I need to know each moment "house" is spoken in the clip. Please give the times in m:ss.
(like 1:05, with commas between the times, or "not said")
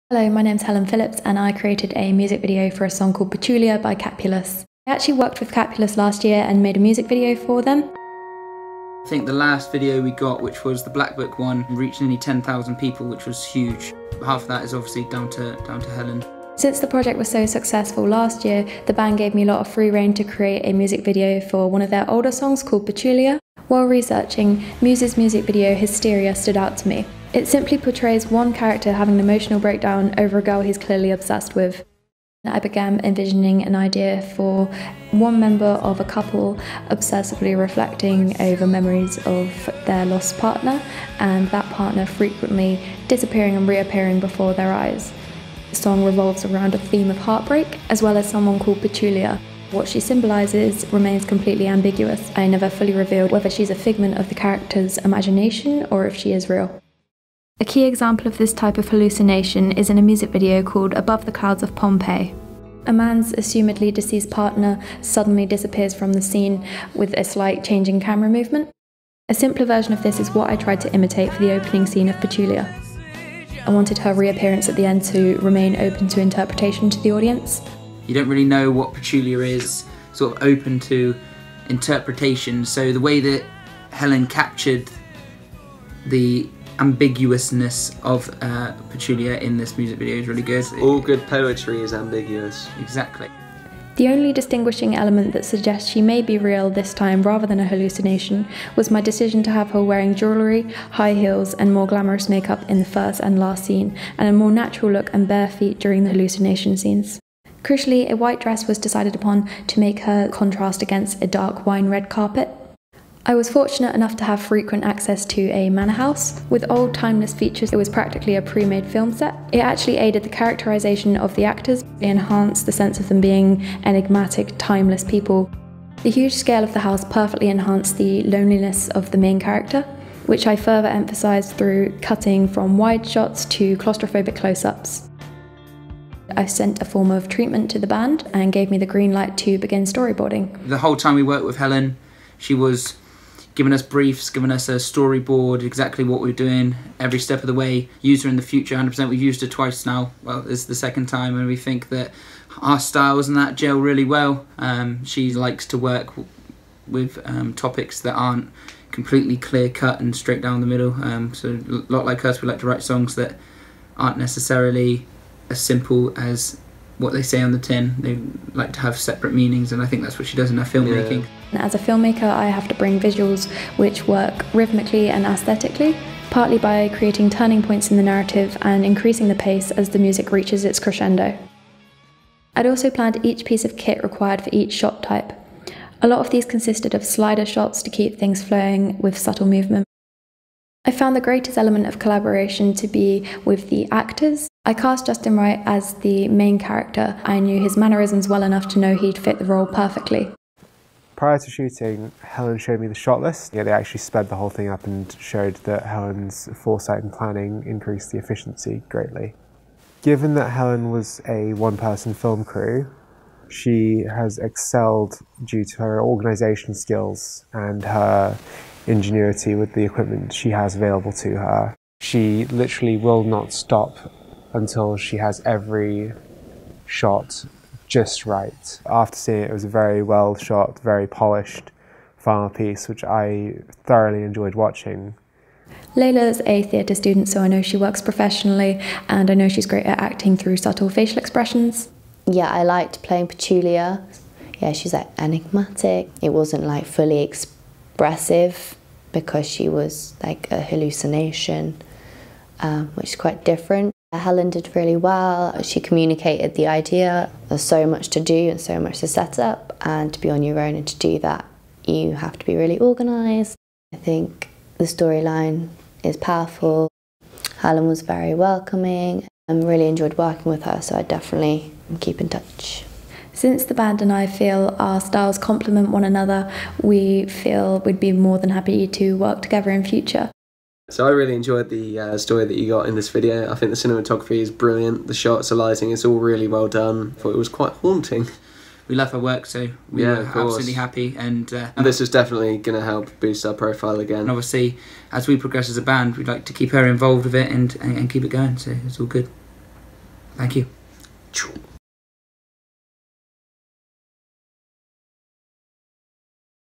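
1:55, 2:06.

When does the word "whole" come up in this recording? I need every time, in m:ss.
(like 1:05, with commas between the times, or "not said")
2:20, 3:24.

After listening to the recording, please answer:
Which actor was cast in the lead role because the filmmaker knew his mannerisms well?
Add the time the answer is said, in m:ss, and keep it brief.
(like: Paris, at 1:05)
Justin Wright, at 3:15.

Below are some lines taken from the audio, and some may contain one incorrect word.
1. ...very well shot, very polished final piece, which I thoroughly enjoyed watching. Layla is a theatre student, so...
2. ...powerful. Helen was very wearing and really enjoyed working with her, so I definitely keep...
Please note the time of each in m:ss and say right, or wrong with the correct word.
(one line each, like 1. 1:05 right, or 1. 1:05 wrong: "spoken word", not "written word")
1. 3:49 right
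2. 4:26 wrong: "welcoming", not "wearing".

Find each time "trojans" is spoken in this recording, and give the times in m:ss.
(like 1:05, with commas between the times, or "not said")
not said.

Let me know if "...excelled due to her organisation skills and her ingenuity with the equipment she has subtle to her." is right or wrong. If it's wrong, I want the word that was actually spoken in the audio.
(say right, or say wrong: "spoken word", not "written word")
wrong: "available", not "subtle".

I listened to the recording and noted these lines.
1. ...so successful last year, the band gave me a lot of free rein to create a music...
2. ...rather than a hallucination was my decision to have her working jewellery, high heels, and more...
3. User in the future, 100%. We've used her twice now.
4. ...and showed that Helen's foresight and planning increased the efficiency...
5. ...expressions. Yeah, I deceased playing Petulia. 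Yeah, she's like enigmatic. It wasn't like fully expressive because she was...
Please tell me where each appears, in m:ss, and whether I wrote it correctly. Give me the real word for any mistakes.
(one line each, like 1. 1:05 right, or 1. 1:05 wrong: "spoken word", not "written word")
1. 0:17 right
2. 1:37 wrong: "wearing", not "working"
3. 2:28 right
4. 3:24 right
5. 4:01 wrong: "liked", not "deceased".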